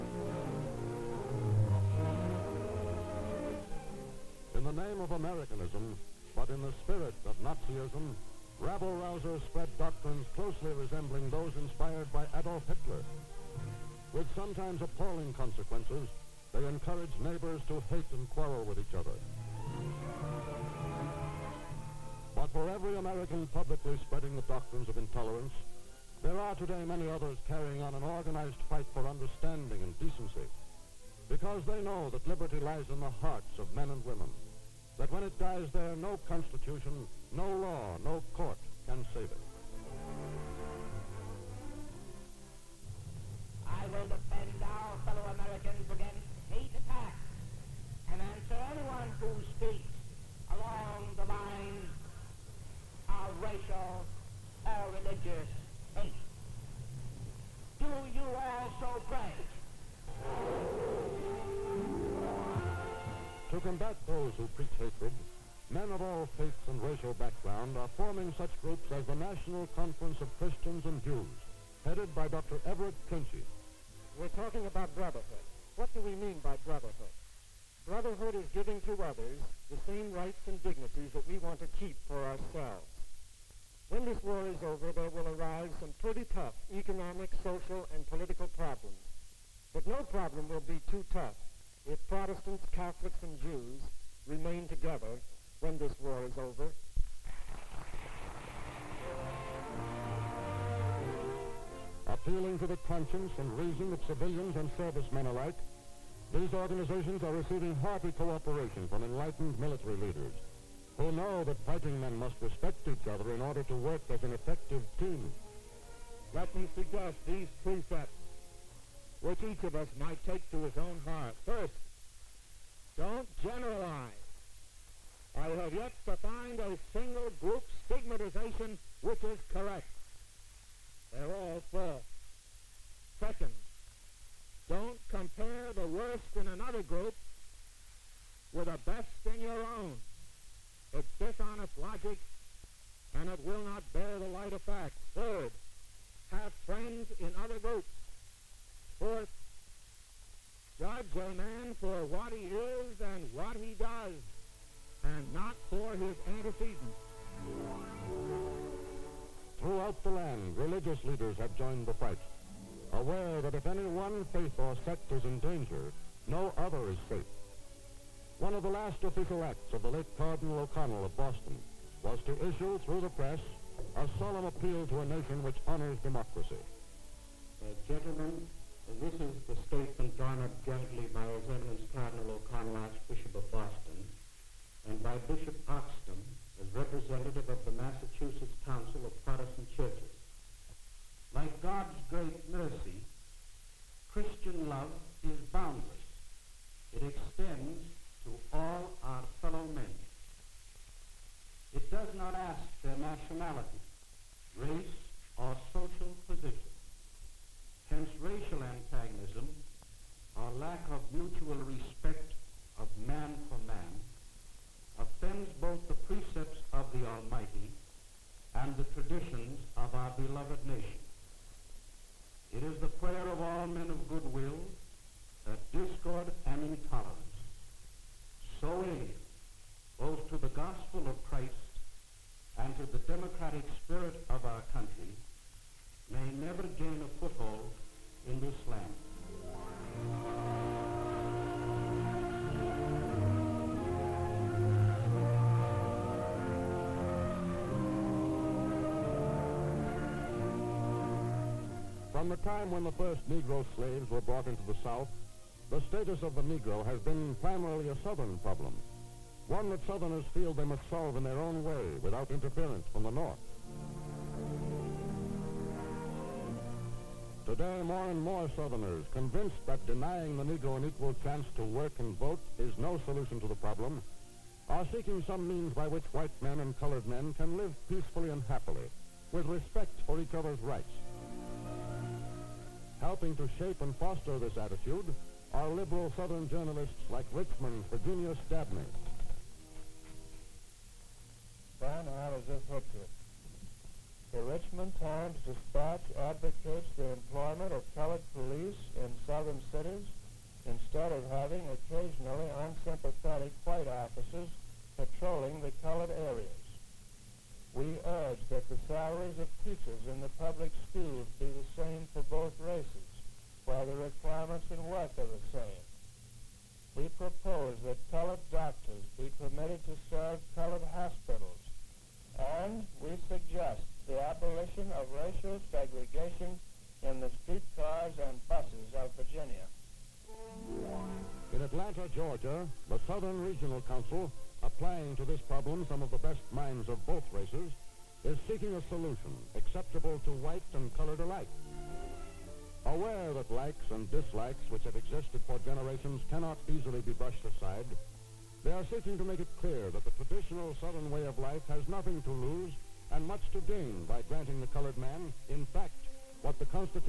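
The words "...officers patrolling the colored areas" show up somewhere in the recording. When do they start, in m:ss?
5:03.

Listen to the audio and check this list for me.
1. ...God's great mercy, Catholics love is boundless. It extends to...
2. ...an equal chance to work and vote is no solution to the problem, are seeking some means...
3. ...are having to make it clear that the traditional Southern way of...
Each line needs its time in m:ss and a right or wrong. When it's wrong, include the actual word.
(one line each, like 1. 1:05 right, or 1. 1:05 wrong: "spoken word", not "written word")
1. 3:11 wrong: "Christian", not "Catholics"
2. 4:30 right
3. 5:48 wrong: "seeking", not "having".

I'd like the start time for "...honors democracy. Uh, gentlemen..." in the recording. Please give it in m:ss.
2:55.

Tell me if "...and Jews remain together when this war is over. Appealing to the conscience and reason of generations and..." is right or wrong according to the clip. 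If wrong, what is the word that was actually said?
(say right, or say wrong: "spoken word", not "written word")
wrong: "civilians", not "generations".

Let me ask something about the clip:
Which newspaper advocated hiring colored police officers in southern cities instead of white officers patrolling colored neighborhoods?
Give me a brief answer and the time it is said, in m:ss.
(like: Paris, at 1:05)
Richmond Times Dispatch, at 4:54.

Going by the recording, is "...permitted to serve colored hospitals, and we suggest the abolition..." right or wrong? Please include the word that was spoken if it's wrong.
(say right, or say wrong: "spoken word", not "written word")
right.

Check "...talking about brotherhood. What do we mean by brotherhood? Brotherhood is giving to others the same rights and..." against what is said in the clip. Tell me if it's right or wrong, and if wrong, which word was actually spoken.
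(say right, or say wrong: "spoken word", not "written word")
right.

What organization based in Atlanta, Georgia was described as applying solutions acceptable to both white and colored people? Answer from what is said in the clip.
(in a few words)
Southern Regional Council.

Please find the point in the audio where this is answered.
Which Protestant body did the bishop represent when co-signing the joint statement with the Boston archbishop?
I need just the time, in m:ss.
3:07.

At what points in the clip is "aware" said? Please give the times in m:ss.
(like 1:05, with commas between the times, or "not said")
2:42, 5:42.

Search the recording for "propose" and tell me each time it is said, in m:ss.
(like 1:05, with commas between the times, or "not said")
5:17.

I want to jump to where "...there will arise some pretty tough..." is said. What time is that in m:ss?
1:24.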